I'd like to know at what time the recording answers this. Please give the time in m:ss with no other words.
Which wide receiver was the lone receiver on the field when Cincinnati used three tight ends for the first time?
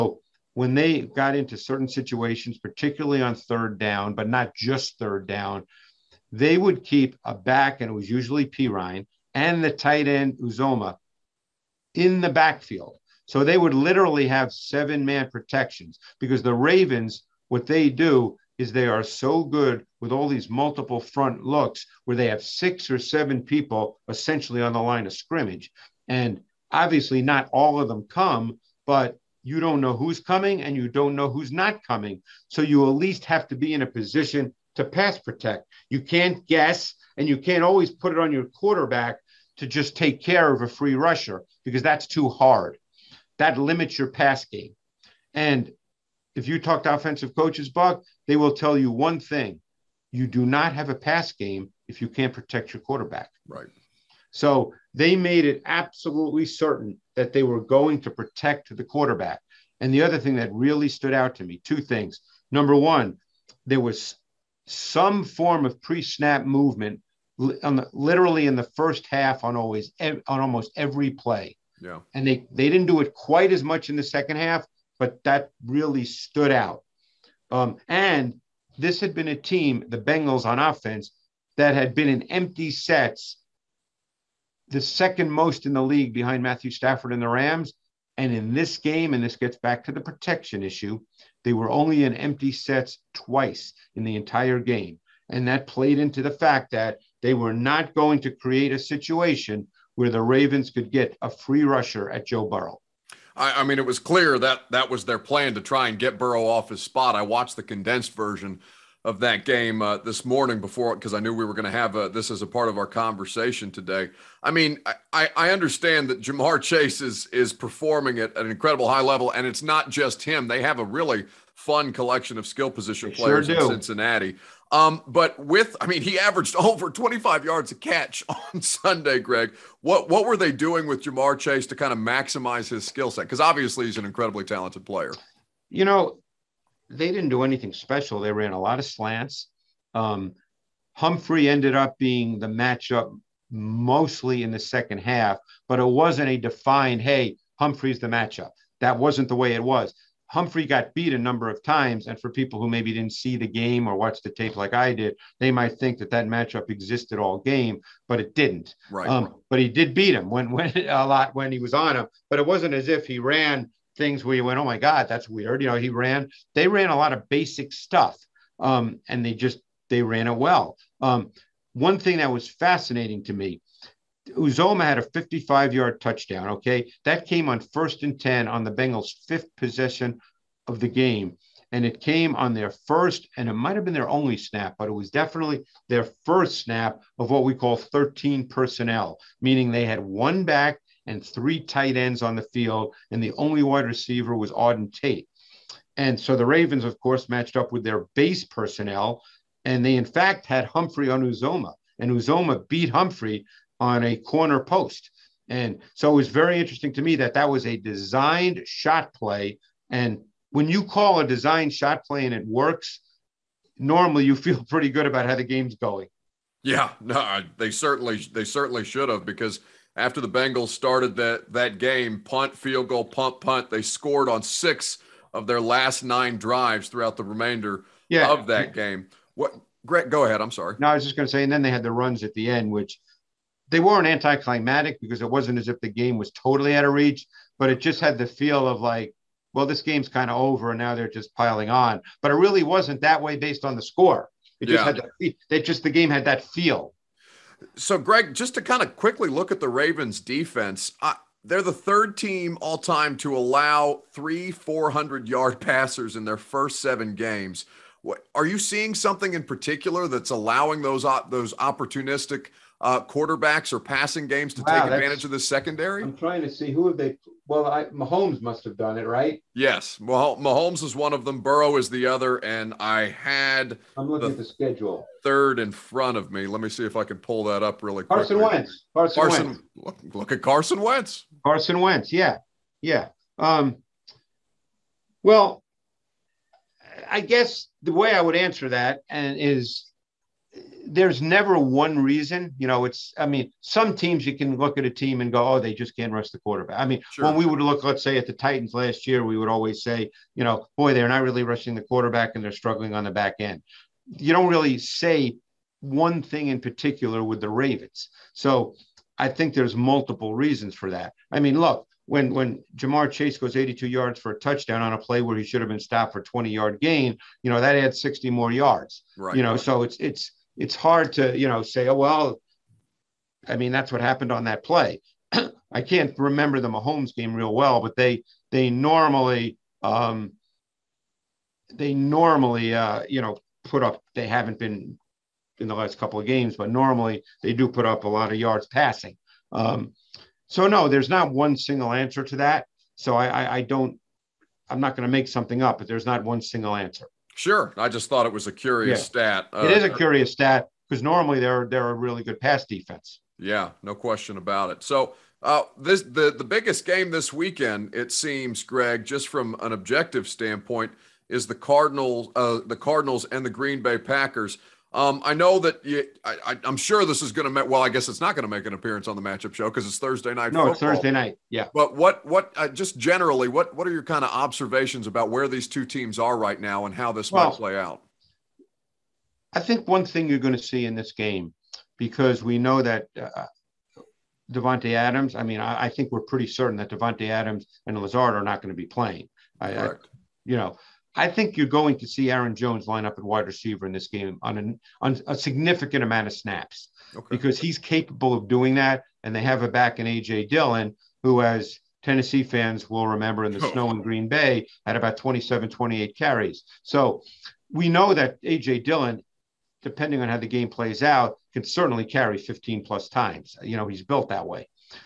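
3:14.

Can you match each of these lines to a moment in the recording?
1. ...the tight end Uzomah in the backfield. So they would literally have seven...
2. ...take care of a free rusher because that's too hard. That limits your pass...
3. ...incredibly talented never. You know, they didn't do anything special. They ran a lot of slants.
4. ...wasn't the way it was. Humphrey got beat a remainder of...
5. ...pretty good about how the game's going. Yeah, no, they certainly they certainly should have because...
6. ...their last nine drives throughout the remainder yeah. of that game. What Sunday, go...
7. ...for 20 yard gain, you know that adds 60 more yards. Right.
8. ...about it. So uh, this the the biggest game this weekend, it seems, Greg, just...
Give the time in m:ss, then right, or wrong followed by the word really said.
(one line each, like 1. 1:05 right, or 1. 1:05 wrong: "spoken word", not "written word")
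1. 0:09 right
2. 0:39 right
3. 2:14 wrong: "player", not "never"
4. 2:28 wrong: "number", not "remainder"
5. 3:34 right
6. 3:45 wrong: "Greg", not "Sunday"
7. 5:16 right
8. 5:54 right.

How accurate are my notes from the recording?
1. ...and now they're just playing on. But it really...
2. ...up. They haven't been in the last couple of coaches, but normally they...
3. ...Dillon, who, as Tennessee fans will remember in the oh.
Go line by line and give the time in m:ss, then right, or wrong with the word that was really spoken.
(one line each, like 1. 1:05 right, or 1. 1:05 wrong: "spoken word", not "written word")
1. 4:00 wrong: "piling", not "playing"
2. 5:33 wrong: "games", not "coaches"
3. 6:40 right.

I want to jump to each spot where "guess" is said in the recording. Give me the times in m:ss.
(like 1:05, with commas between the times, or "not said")
0:36, 4:47, 6:07.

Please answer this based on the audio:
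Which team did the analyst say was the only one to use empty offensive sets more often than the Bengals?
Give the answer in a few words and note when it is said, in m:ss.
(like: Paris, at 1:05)
Rams, at 1:27.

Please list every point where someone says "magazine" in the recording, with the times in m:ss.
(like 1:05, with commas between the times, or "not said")
not said.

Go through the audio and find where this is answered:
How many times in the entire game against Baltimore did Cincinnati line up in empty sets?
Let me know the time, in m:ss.
1:33.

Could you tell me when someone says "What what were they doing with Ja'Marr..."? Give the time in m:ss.
2:09.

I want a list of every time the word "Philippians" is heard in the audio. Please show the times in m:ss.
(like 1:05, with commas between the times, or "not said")
not said.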